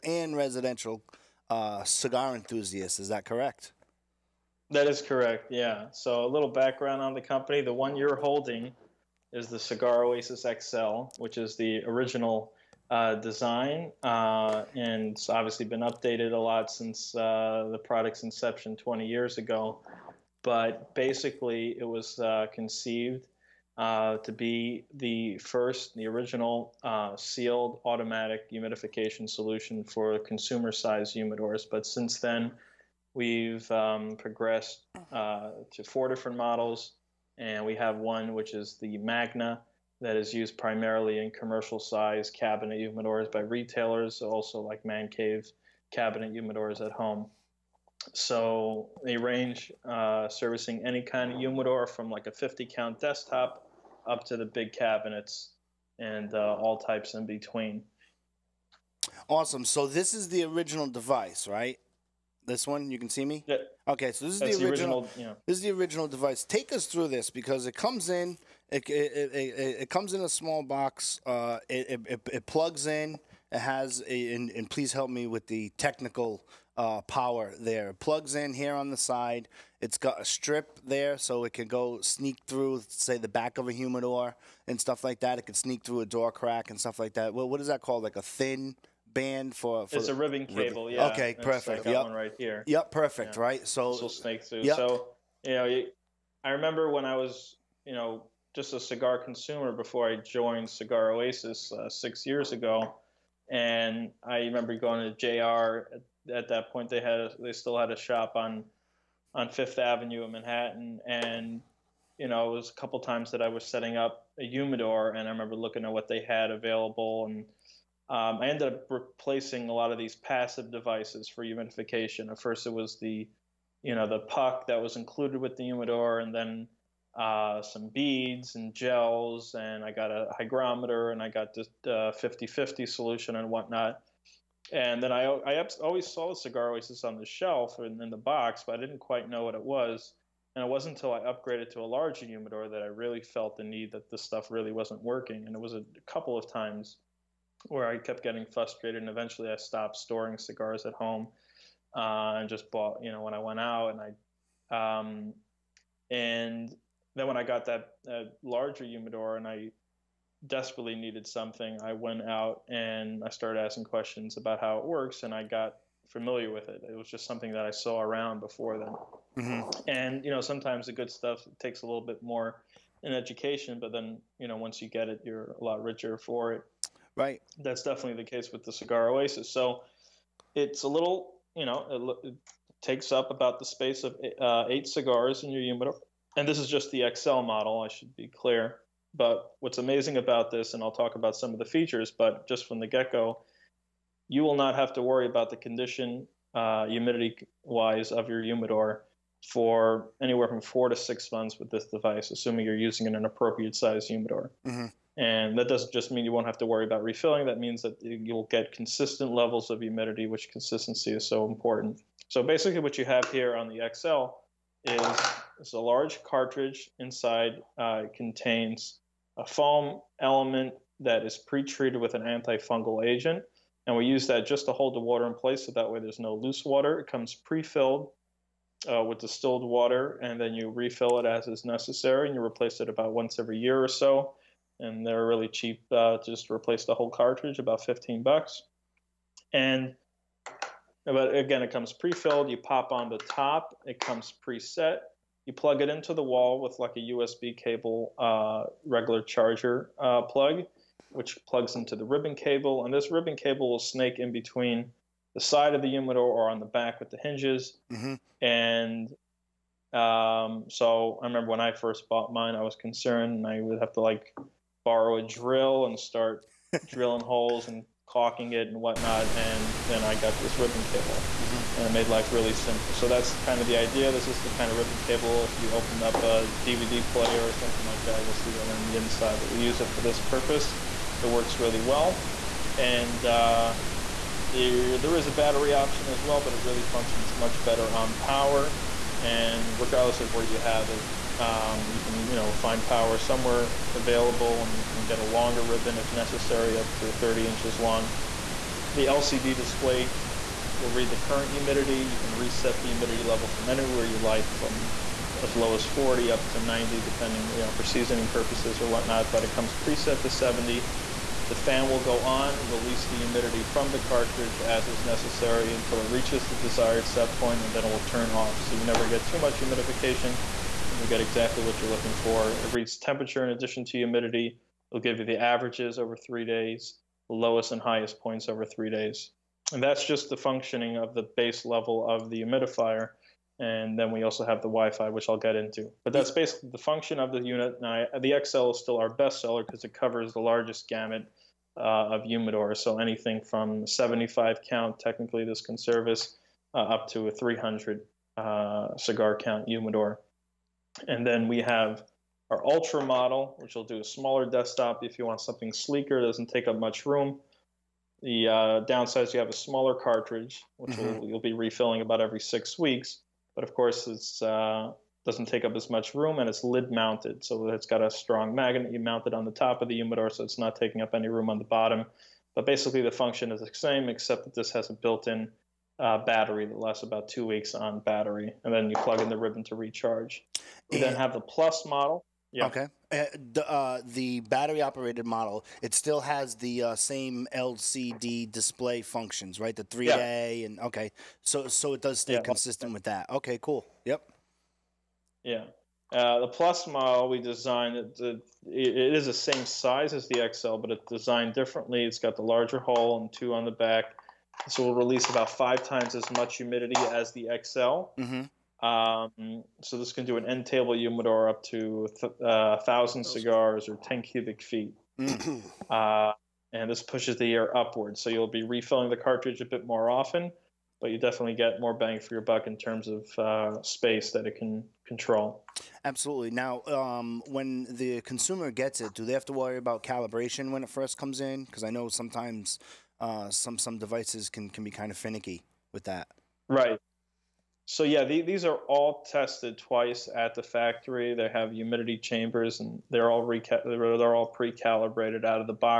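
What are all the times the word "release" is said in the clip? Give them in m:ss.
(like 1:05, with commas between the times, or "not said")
5:12, 6:44.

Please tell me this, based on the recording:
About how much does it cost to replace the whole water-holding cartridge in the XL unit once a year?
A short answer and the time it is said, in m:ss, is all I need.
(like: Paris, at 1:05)
$15, at 3:57.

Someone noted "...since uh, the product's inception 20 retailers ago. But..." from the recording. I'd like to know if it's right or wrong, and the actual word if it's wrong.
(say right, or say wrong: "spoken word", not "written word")
wrong: "years", not "retailers".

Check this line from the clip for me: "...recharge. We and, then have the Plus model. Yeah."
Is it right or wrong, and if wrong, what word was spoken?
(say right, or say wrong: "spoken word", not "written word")
right.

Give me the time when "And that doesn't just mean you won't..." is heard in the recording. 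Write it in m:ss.
3:25.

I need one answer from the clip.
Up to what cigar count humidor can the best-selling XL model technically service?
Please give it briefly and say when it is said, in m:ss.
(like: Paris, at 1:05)
300, at 5:47.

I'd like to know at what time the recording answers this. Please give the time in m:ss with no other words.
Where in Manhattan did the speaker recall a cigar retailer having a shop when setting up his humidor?
1:49.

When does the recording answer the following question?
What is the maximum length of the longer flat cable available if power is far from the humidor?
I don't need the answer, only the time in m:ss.
4:57.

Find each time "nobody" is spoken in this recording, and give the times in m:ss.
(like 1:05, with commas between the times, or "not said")
not said.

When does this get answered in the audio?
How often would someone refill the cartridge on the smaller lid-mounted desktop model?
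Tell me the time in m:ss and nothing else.
6:02.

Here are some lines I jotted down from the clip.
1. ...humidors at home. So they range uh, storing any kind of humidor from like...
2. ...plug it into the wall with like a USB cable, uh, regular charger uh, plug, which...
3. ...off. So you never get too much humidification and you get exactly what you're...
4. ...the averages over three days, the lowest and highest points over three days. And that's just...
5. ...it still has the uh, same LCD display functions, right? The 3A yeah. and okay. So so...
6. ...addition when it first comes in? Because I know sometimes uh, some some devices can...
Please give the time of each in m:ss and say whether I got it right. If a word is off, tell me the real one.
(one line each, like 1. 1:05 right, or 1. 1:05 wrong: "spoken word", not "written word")
1. 0:46 wrong: "servicing", not "storing"
2. 4:05 right
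3. 5:18 right
4. 5:25 right
5. 6:25 right
6. 7:10 wrong: "calibration", not "addition".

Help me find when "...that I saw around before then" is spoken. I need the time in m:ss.
2:47.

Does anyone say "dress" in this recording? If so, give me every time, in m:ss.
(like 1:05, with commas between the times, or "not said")
not said.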